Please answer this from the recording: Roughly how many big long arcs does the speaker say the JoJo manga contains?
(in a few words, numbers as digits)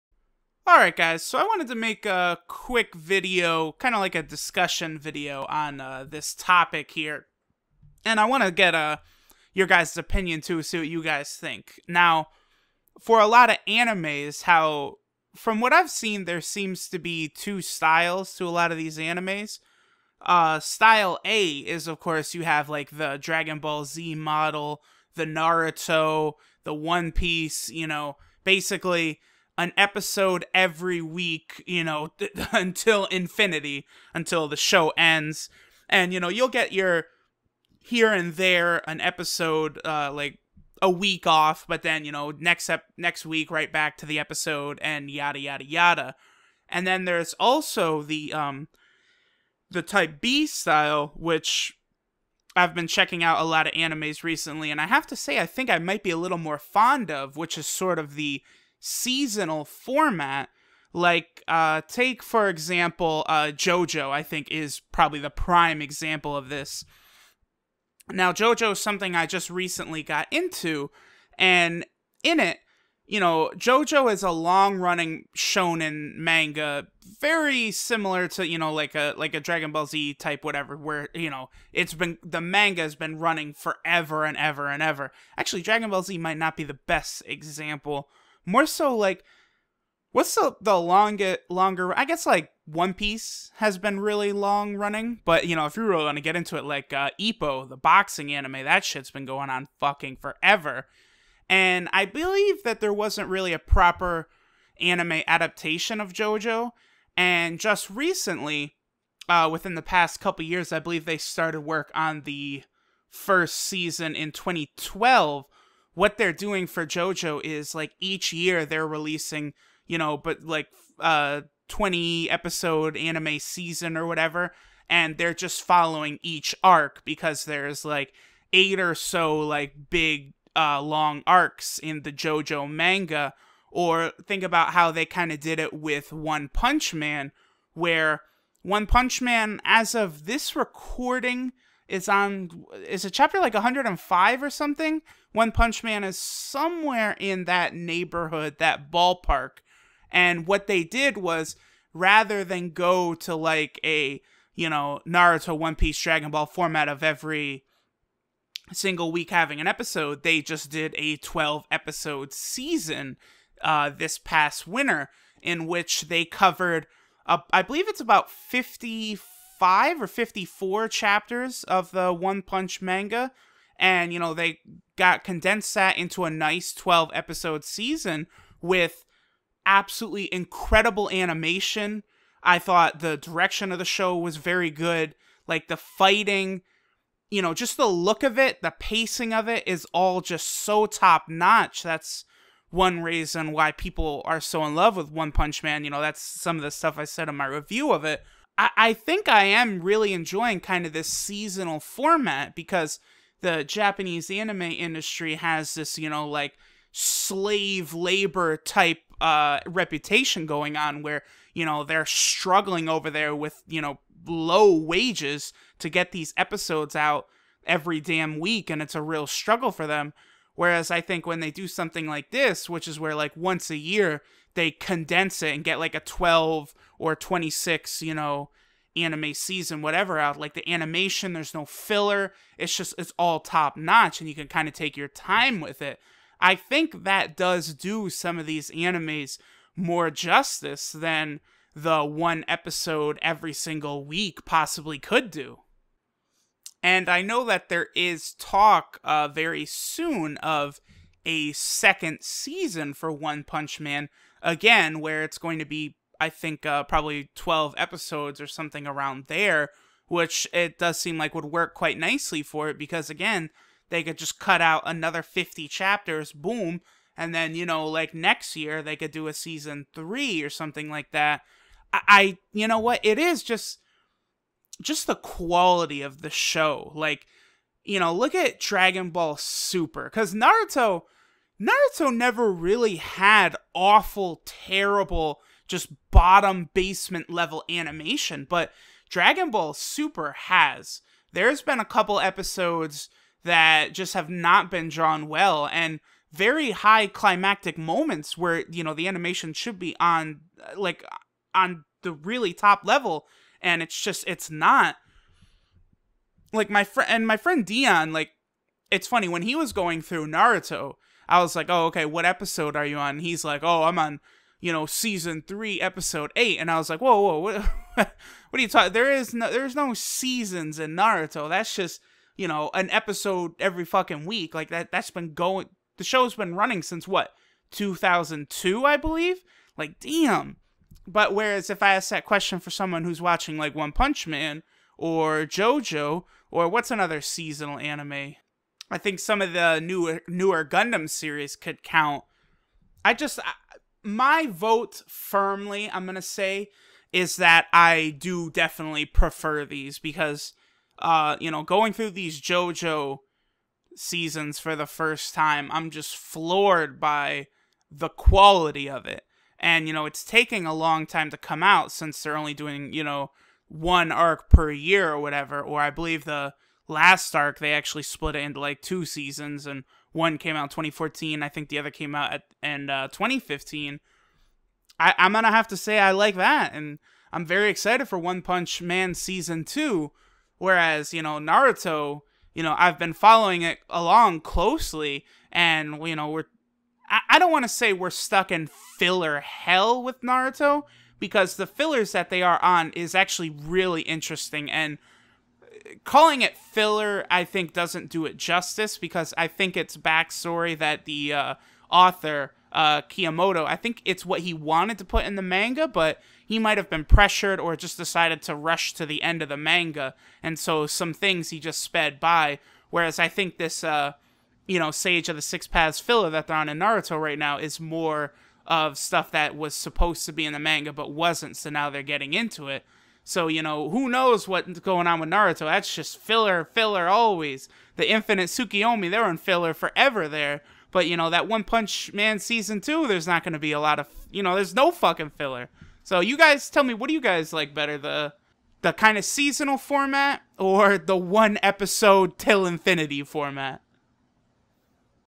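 8.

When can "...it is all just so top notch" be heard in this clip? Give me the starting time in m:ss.
3:09.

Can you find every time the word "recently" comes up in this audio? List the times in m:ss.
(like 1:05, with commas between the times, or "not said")
0:54, 1:09, 1:47.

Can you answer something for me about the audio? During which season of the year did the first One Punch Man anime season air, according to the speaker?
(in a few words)
Winter.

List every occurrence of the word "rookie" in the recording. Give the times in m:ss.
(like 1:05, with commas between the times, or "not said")
not said.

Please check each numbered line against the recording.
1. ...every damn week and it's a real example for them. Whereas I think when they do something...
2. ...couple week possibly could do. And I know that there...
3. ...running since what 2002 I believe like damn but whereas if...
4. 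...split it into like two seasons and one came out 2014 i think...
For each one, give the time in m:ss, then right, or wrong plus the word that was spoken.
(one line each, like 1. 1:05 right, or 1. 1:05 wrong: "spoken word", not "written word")
1. 3:37 wrong: "struggle", not "example"
2. 4:03 wrong: "single", not "couple"
3. 5:26 right
4. 6:08 right.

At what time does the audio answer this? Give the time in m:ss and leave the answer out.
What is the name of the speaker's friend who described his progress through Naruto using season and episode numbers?
5:07.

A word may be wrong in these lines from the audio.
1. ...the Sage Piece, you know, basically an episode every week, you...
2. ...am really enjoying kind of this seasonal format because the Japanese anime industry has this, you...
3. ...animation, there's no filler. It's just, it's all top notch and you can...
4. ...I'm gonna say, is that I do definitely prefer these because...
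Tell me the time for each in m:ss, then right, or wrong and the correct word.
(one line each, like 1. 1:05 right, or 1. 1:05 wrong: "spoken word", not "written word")
1. 0:26 wrong: "One", not "Sage"
2. 3:19 right
3. 3:50 right
4. 5:45 right.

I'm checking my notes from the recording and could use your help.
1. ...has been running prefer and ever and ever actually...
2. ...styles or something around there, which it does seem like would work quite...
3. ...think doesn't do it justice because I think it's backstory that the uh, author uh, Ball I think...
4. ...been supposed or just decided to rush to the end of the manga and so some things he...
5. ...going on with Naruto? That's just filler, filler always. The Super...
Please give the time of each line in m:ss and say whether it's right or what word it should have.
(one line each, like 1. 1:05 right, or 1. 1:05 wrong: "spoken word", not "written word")
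1. 1:22 wrong: "forever", not "prefer"
2. 4:17 wrong: "episodes", not "styles"
3. 6:37 wrong: "Kiyamoto", not "Ball"
4. 6:46 wrong: "pressured", not "supposed"
5. 7:04 wrong: "Infinite", not "Super".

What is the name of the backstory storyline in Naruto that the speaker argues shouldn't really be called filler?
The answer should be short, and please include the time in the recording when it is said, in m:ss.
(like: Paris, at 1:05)
Sage of the Six Paths, at 6:54.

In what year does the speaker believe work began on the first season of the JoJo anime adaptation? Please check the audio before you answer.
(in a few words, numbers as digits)
2012.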